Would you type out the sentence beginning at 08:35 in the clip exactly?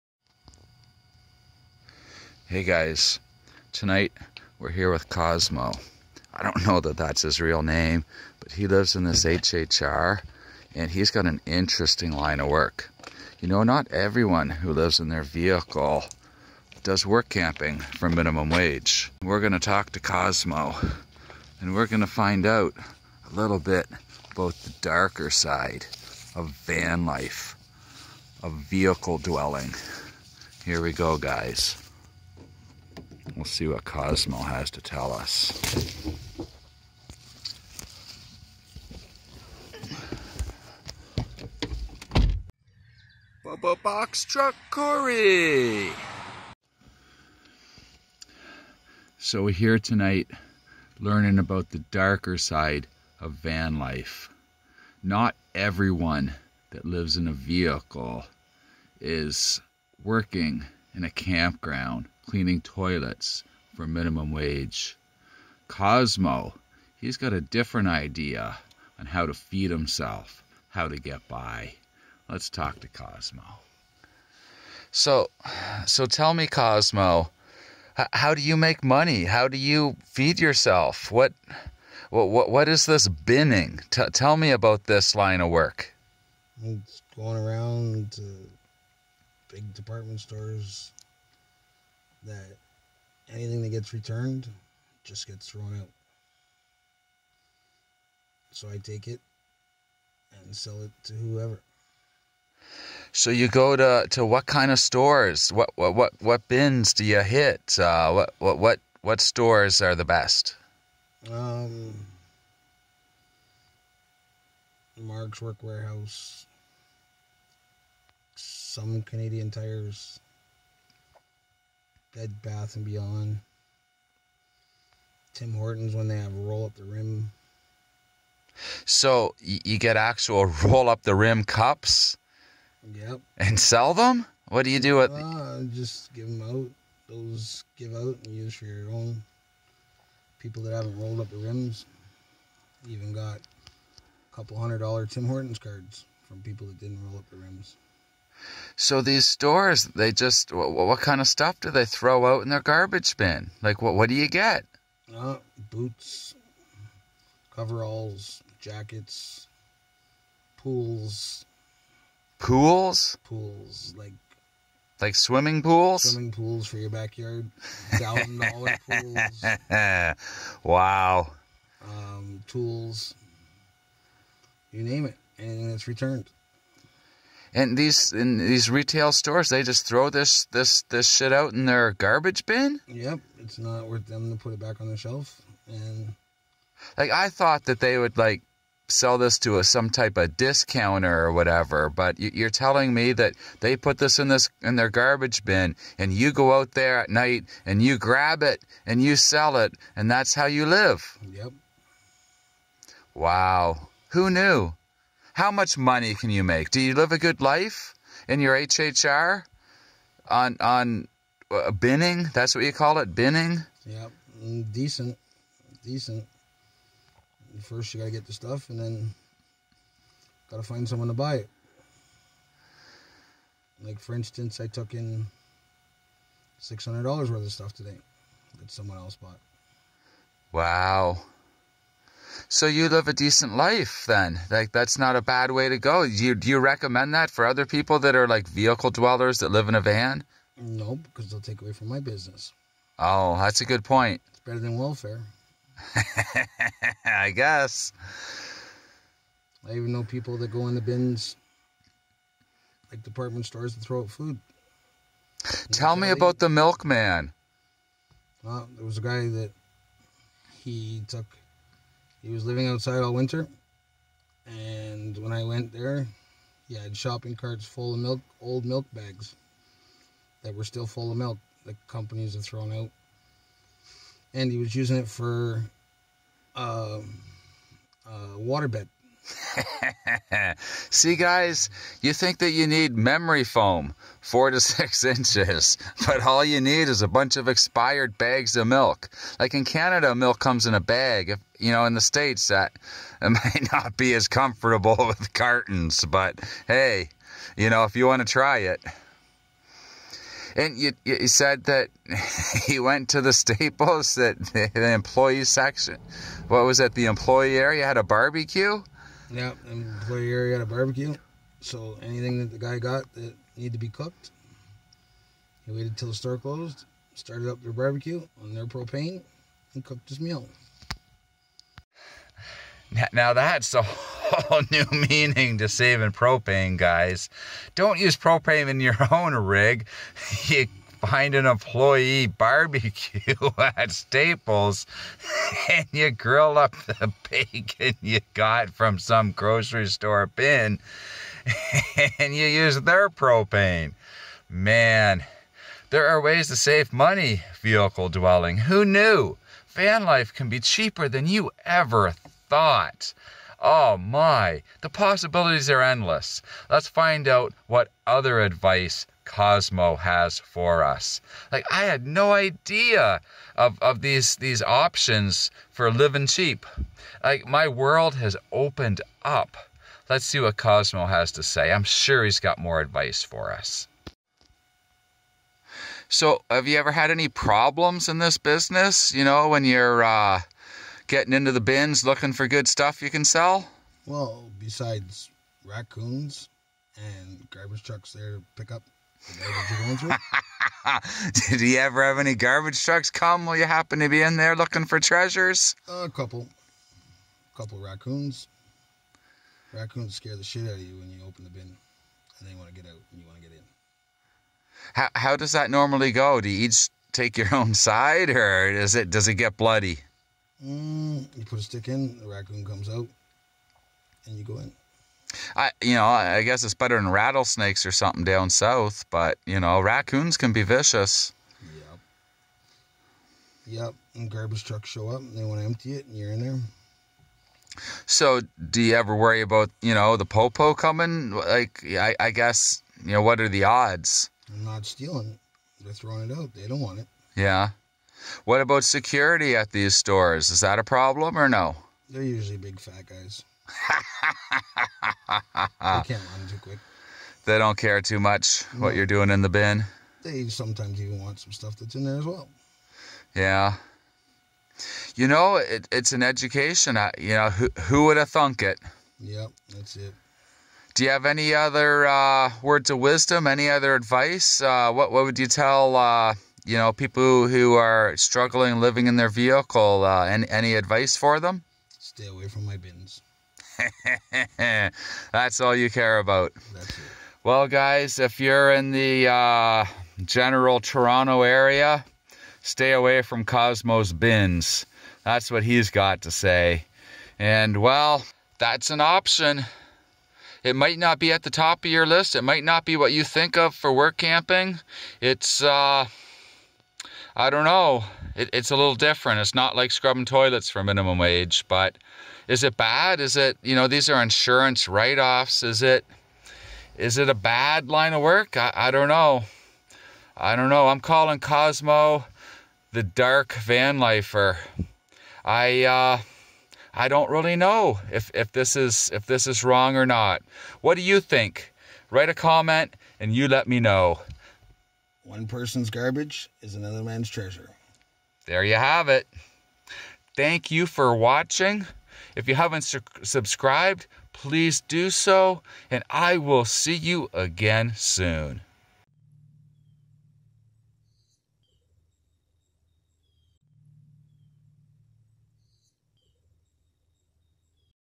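I, uh, I don't really know if, if this is if this is wrong or not.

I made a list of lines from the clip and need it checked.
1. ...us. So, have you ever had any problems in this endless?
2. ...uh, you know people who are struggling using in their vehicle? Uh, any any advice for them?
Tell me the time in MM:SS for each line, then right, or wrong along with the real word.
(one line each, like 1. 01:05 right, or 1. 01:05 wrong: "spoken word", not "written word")
1. 06:13 wrong: "business", not "endless"
2. 07:45 wrong: "living", not "using".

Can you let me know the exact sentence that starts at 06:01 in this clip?
Like I had no idea of, of these these options for living cheap.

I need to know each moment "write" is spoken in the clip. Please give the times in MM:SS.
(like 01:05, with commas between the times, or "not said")
08:24, 08:42.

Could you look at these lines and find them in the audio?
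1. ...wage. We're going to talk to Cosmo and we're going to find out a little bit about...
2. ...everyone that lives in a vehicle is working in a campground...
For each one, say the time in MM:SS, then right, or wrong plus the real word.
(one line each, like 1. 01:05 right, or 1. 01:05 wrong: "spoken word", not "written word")
1. 00:18 right
2. 00:55 right.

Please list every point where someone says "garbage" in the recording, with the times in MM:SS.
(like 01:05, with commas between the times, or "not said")
02:32, 03:01, 03:14, 06:27, 06:32, 07:04, 08:45.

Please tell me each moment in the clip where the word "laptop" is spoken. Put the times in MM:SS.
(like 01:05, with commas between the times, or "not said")
not said.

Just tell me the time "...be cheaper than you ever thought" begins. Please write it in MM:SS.
05:50.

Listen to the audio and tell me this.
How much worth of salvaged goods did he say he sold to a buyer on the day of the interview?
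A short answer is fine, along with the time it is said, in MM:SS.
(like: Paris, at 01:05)
$600, at 03:46.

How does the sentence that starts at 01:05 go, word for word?
Cosmo, he's got a different idea on how to feed himself, how to get by.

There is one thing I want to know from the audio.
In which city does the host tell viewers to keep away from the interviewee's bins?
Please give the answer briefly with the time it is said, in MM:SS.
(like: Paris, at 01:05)
Toronto, at 08:00.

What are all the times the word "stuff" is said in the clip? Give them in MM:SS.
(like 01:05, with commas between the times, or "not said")
02:31, 03:38, 03:47, 06:22, 07:31.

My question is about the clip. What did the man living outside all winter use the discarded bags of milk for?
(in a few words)
A water bed.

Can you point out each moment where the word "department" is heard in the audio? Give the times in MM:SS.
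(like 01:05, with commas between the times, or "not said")
01:29, 04:13.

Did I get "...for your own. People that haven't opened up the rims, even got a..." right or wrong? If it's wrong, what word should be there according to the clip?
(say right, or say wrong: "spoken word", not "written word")
wrong: "rolled", not "opened".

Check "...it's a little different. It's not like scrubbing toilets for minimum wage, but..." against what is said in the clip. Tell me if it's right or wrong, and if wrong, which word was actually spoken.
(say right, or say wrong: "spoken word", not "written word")
right.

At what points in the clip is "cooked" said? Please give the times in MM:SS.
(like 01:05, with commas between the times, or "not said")
05:13, 05:19.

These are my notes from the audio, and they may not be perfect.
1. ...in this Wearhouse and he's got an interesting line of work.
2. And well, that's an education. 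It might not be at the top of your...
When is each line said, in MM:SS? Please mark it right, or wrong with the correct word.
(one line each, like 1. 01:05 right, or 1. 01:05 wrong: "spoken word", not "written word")
1. 00:08 wrong: "HHR", not "Wearhouse"
2. 08:07 wrong: "option", not "education".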